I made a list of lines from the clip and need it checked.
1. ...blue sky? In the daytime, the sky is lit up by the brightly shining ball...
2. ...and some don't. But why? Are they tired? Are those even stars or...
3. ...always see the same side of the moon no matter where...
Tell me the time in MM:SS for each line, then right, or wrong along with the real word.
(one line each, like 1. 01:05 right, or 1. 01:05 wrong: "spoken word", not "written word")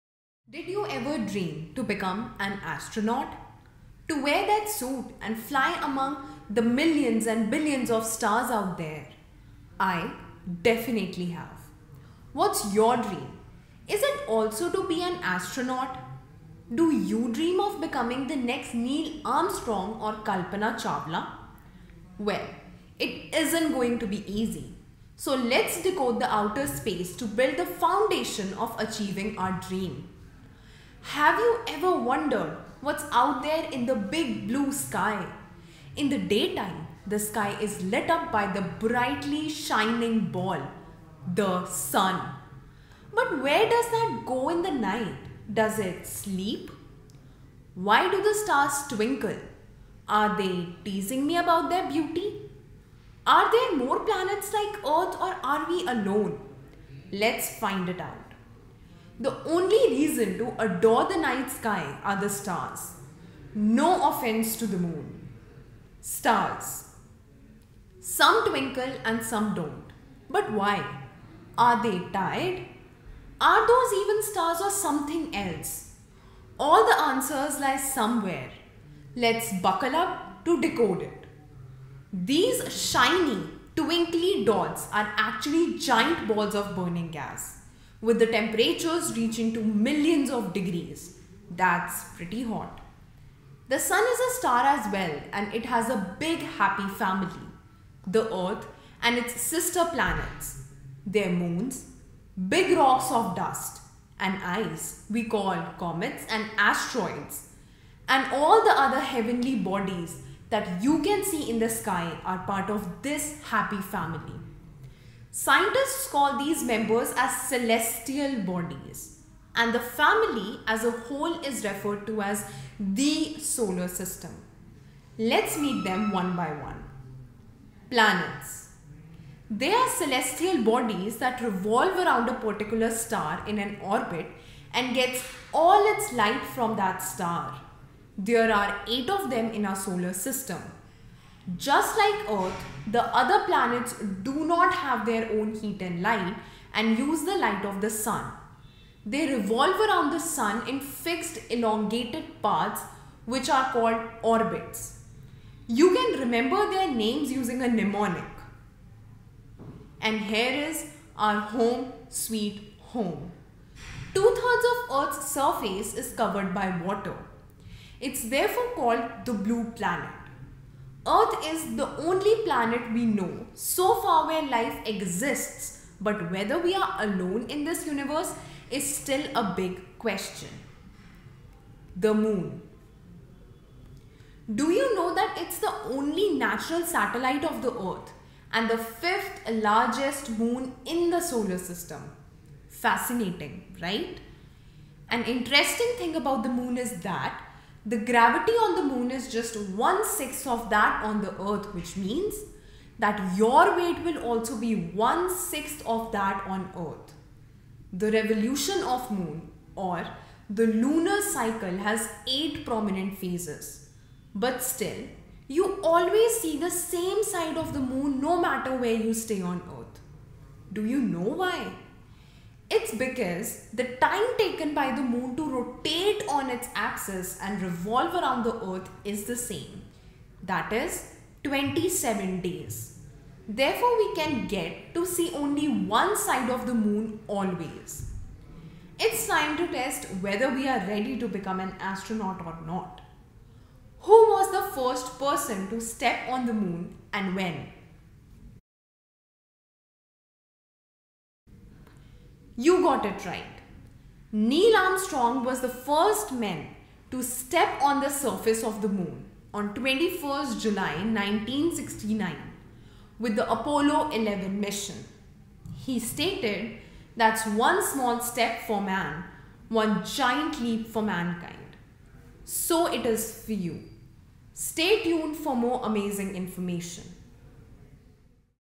1. 00:34 right
2. 01:09 right
3. 03:35 right.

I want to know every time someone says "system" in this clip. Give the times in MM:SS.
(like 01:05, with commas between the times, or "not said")
02:03, 02:20, 03:11.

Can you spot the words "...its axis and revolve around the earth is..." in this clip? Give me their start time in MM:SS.
03:46.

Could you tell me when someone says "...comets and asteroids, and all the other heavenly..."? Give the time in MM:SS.
01:45.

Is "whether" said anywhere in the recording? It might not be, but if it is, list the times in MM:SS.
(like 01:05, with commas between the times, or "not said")
02:56, 04:00.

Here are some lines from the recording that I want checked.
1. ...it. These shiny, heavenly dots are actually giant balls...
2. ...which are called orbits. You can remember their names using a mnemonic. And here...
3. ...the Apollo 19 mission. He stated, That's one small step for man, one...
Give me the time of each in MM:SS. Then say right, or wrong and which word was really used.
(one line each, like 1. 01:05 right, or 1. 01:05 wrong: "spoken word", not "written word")
1. 01:21 wrong: "twinkly", not "heavenly"
2. 02:33 right
3. 04:23 wrong: "11", not "19".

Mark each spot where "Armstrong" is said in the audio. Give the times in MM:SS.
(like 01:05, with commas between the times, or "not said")
00:19, 04:14.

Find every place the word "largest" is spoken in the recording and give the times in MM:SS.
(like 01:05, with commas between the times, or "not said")
03:09.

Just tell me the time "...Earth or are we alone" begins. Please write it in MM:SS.
00:54.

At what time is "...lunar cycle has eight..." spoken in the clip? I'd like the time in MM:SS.
03:30.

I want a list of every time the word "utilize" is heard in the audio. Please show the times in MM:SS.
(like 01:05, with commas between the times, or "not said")
not said.